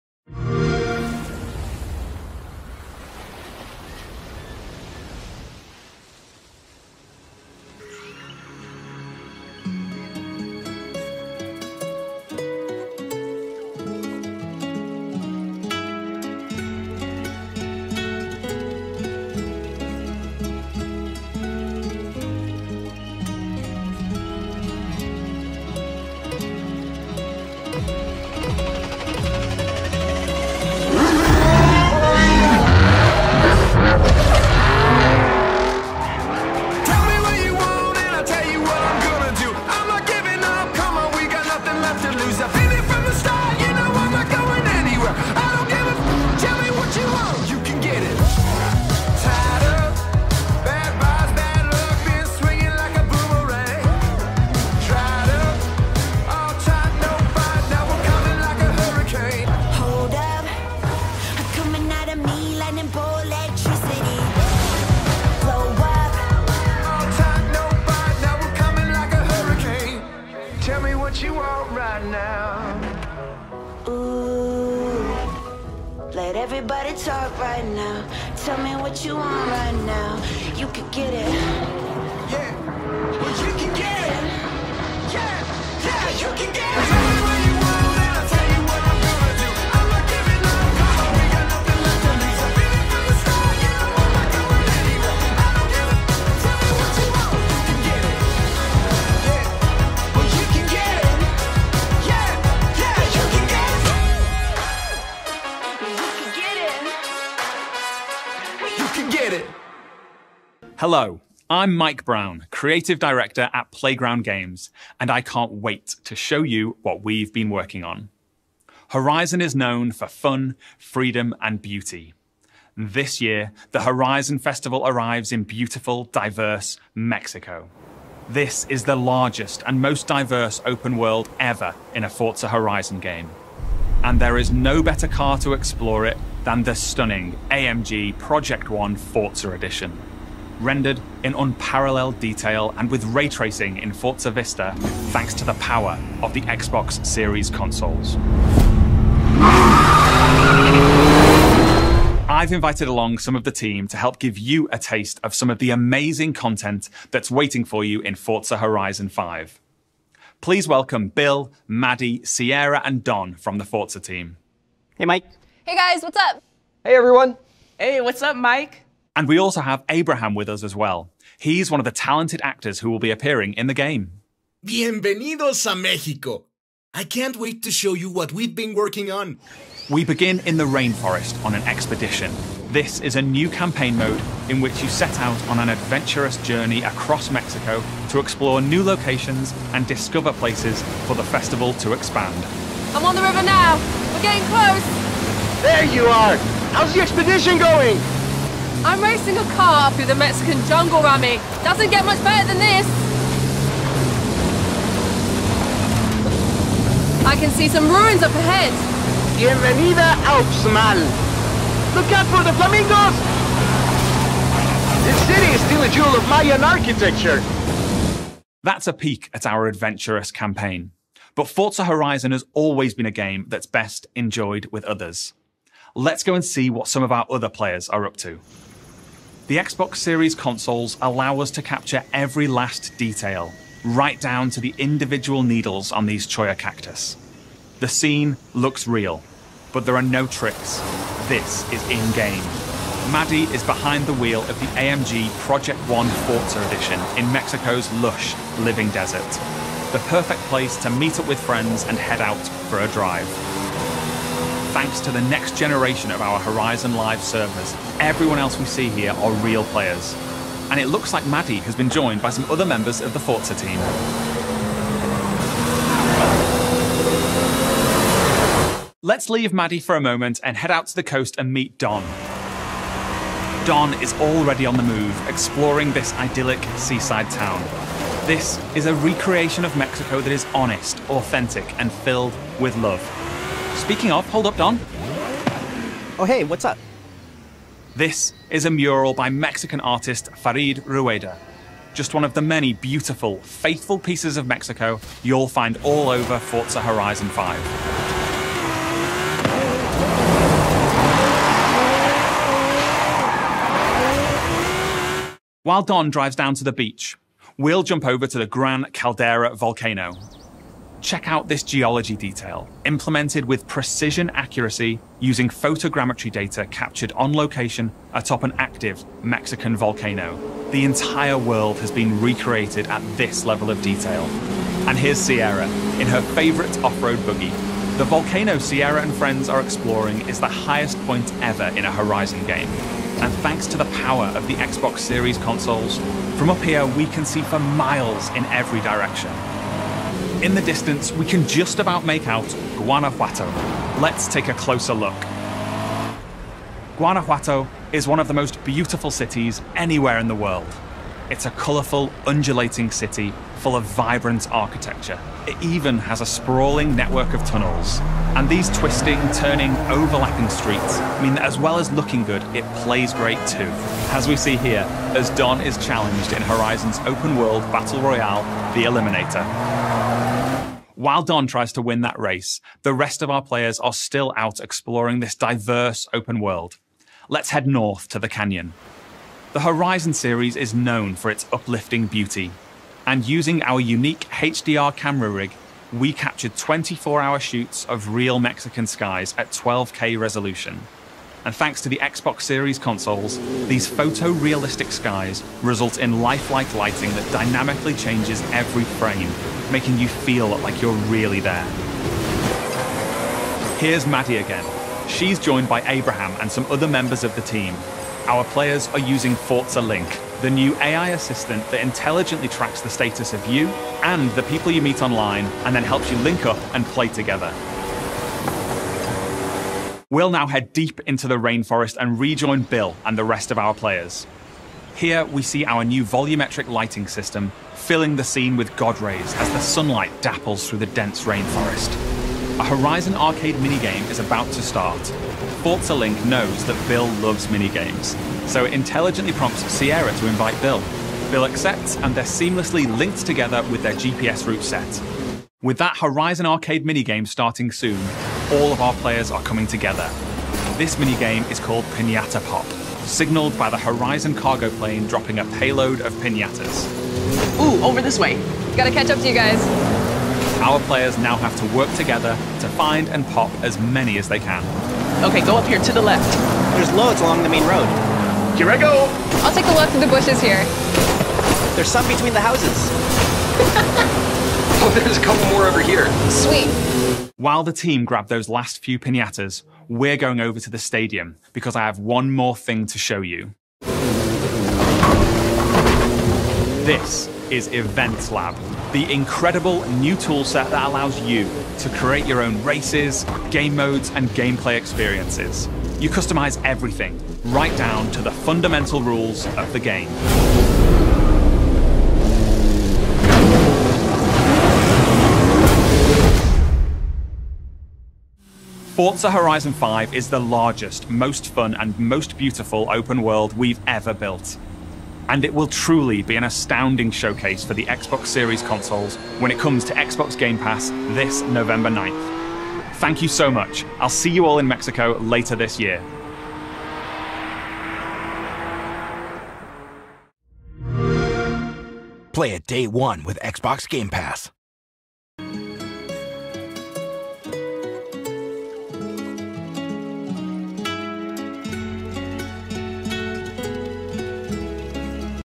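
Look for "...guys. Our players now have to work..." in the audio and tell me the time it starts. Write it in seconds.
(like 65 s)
459 s.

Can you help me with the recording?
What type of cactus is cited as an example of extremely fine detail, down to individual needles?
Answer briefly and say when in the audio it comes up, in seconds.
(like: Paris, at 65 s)
Cholla, at 236 s.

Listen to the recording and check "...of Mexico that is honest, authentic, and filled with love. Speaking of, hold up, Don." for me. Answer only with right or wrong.
right.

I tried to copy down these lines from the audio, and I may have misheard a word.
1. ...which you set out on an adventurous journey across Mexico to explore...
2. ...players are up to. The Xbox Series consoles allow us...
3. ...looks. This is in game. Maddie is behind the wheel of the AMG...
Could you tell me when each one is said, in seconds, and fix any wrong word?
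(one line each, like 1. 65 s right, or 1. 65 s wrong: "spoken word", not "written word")
1. 184 s right
2. 227 s right
3. 240 s wrong: "tricks", not "looks".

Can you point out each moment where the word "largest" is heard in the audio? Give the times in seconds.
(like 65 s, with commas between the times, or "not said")
128 s, 510 s.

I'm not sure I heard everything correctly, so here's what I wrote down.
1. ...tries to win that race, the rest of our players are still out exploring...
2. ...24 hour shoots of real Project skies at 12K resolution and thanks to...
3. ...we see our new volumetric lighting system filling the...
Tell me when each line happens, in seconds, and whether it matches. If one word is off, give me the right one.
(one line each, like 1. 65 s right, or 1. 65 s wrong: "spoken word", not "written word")
1. 371 s right
2. 386 s wrong: "Mexican", not "Project"
3. 425 s right.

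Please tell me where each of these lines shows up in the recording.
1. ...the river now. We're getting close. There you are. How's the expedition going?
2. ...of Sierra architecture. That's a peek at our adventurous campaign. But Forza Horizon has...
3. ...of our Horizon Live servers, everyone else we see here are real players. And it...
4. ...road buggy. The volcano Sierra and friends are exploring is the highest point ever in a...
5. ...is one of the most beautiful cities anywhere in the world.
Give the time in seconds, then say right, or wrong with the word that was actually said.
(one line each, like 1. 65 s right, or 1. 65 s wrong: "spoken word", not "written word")
1. 193 s right
2. 216 s wrong: "Mayan", not "Sierra"
3. 256 s right
4. 327 s right
5. 347 s right.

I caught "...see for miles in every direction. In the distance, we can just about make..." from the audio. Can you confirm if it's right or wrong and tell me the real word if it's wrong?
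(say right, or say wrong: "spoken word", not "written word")
right.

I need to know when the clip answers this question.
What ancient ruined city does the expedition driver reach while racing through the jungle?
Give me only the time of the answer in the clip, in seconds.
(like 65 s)
210 s.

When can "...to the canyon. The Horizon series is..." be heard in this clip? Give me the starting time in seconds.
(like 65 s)
378 s.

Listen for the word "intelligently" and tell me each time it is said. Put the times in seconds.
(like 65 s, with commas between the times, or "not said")
411 s, 438 s.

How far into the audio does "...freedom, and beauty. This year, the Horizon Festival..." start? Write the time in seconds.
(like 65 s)
120 s.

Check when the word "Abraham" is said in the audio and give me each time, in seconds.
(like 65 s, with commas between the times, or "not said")
169 s, 405 s.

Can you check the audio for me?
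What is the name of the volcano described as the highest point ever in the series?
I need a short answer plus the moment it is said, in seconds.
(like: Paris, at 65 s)
Gran Caldera, at 308 s.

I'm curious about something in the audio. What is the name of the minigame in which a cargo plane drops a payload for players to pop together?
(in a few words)
Piñata Pop.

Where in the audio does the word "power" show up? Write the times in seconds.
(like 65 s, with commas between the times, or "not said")
145 s, 333 s.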